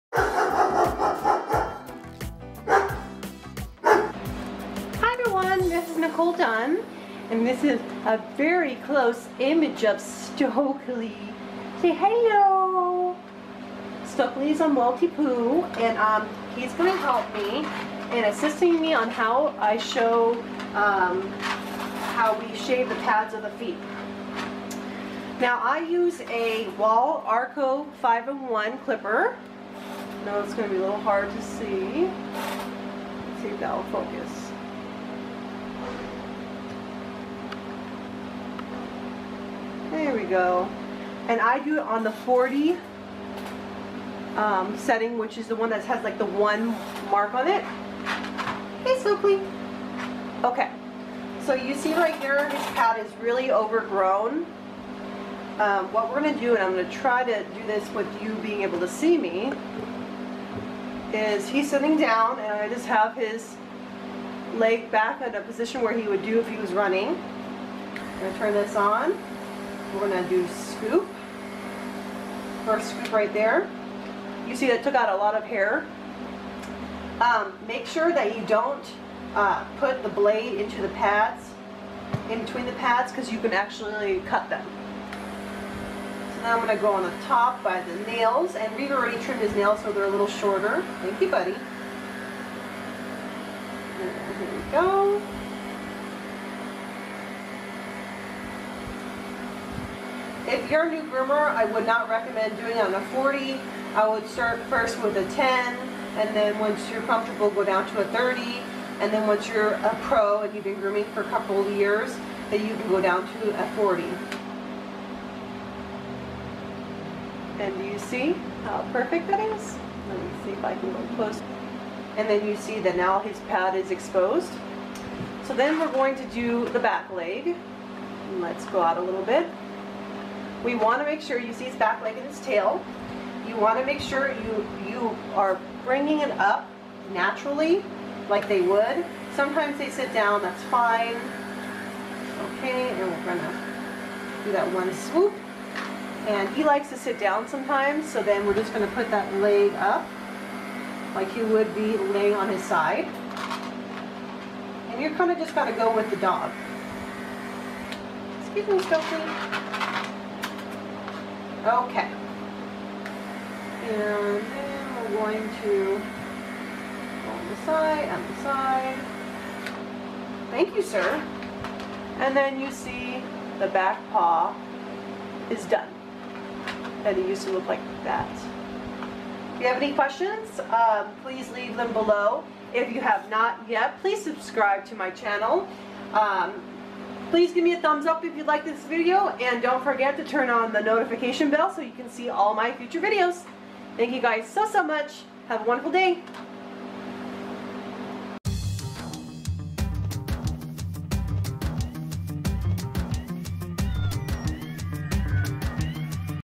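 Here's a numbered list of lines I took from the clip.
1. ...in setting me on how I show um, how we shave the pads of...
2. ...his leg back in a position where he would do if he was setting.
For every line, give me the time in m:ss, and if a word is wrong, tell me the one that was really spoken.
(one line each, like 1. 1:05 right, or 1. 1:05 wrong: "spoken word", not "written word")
1. 0:18 wrong: "assisting", not "setting"
2. 1:03 wrong: "running", not "setting".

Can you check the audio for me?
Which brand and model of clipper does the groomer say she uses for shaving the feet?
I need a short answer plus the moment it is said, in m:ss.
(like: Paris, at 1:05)
Wahl Arco 5-in-1, at 0:26.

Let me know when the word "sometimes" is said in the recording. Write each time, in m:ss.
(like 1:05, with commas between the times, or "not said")
2:19, 2:27.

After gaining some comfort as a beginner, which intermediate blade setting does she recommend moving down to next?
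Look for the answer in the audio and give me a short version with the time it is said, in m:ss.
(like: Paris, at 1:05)
30, at 1:48.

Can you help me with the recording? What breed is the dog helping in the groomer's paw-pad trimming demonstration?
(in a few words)
Maltipoo.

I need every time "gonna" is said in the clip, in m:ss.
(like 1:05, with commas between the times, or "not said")
2:23, 2:28.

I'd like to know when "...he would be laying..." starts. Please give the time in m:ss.
2:31.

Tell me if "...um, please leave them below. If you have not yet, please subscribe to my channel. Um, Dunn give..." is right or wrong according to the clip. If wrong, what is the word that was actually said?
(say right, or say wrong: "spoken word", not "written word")
wrong: "Please", not "Dunn".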